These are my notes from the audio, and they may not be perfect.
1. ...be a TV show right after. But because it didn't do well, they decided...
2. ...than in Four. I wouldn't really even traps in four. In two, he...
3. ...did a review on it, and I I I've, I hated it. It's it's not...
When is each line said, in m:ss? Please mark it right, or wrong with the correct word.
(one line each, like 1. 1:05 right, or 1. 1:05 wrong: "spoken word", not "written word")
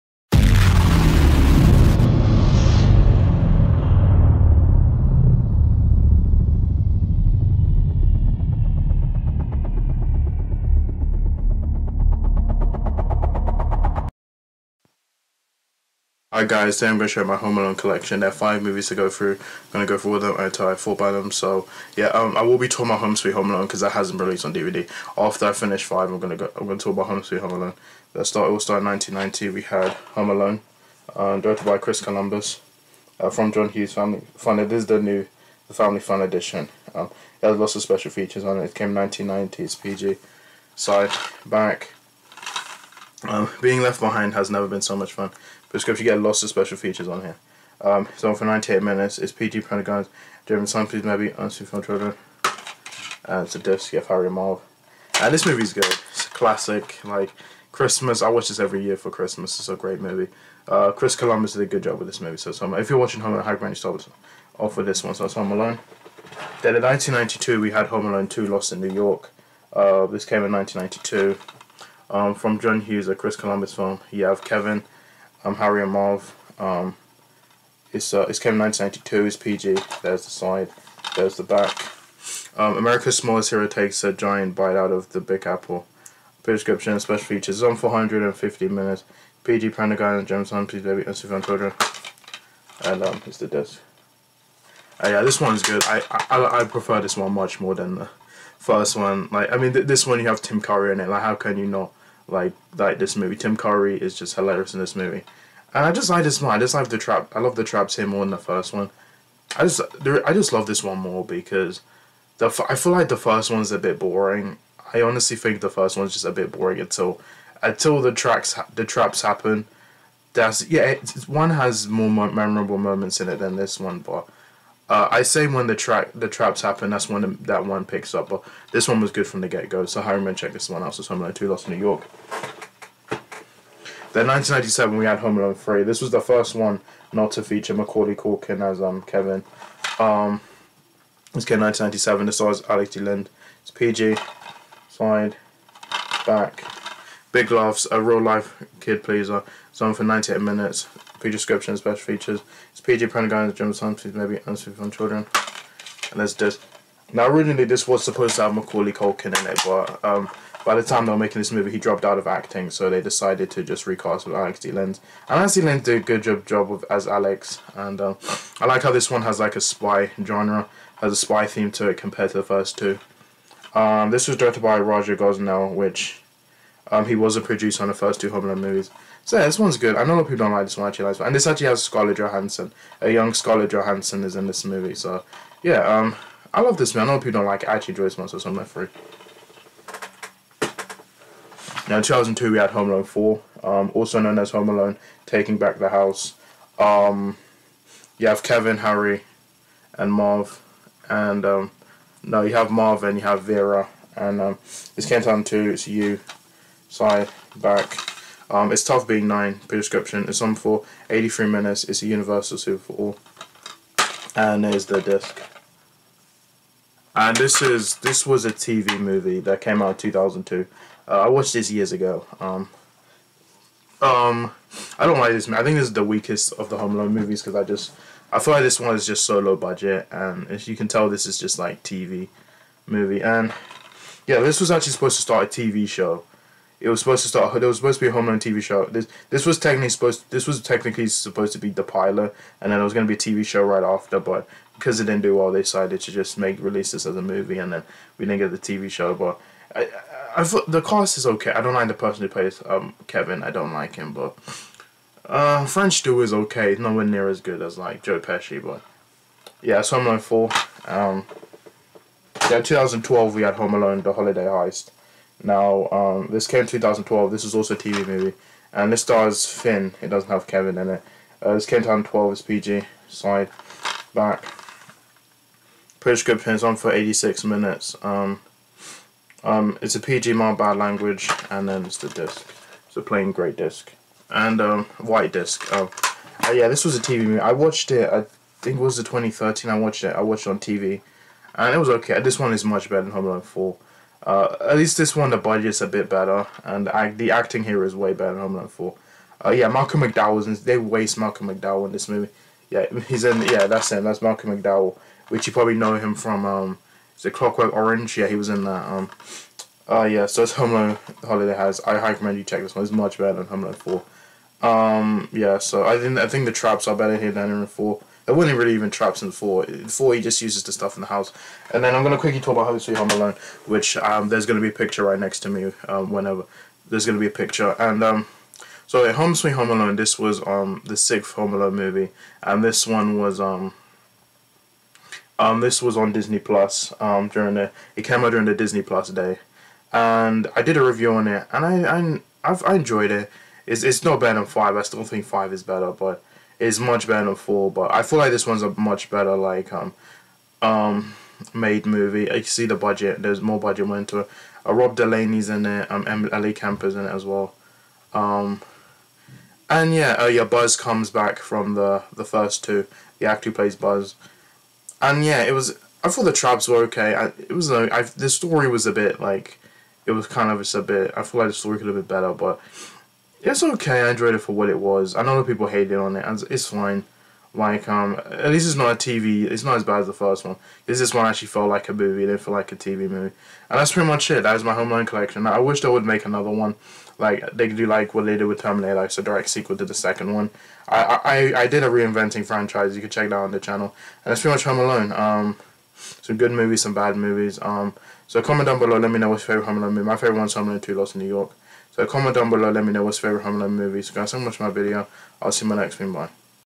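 1. 4:03 right
2. 5:17 wrong: "four", not "two"
3. 5:40 wrong: "enjoyed", not "hated".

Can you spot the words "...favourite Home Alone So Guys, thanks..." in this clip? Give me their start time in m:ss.
6:43.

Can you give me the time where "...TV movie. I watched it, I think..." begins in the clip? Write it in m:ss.
4:46.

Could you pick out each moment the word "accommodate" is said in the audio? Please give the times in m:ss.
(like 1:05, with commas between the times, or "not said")
not said.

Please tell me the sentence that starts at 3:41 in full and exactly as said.
Uh, I watched this years ago.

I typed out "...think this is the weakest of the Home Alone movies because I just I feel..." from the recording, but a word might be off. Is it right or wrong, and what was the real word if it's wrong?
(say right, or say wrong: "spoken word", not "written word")
right.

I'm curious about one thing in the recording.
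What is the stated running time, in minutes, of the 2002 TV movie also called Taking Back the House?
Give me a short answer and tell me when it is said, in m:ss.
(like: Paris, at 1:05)
83, at 3:31.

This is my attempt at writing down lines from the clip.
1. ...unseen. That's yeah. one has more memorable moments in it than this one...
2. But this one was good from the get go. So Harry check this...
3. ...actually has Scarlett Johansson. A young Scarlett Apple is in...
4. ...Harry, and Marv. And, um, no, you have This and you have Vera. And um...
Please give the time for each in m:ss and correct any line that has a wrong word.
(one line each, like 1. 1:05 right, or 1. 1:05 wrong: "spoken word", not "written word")
1. 1:59 wrong: "happen", not "unseen"
2. 2:08 right
3. 3:01 wrong: "Johansson", not "Apple"
4. 3:18 wrong: "Marv", not "This".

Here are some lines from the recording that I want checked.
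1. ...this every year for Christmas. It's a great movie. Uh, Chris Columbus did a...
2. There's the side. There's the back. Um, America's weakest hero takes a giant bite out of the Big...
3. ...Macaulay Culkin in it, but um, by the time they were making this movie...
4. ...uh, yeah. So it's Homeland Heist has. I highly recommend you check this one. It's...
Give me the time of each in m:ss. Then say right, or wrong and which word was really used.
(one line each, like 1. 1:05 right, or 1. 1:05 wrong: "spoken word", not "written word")
1. 0:58 right
2. 1:20 wrong: "smallest", not "weakest"
3. 2:38 right
4. 5:09 wrong: "Holiday", not "Heist".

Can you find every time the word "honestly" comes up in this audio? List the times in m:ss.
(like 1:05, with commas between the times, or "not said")
1:55.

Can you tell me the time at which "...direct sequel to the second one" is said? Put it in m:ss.
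6:29.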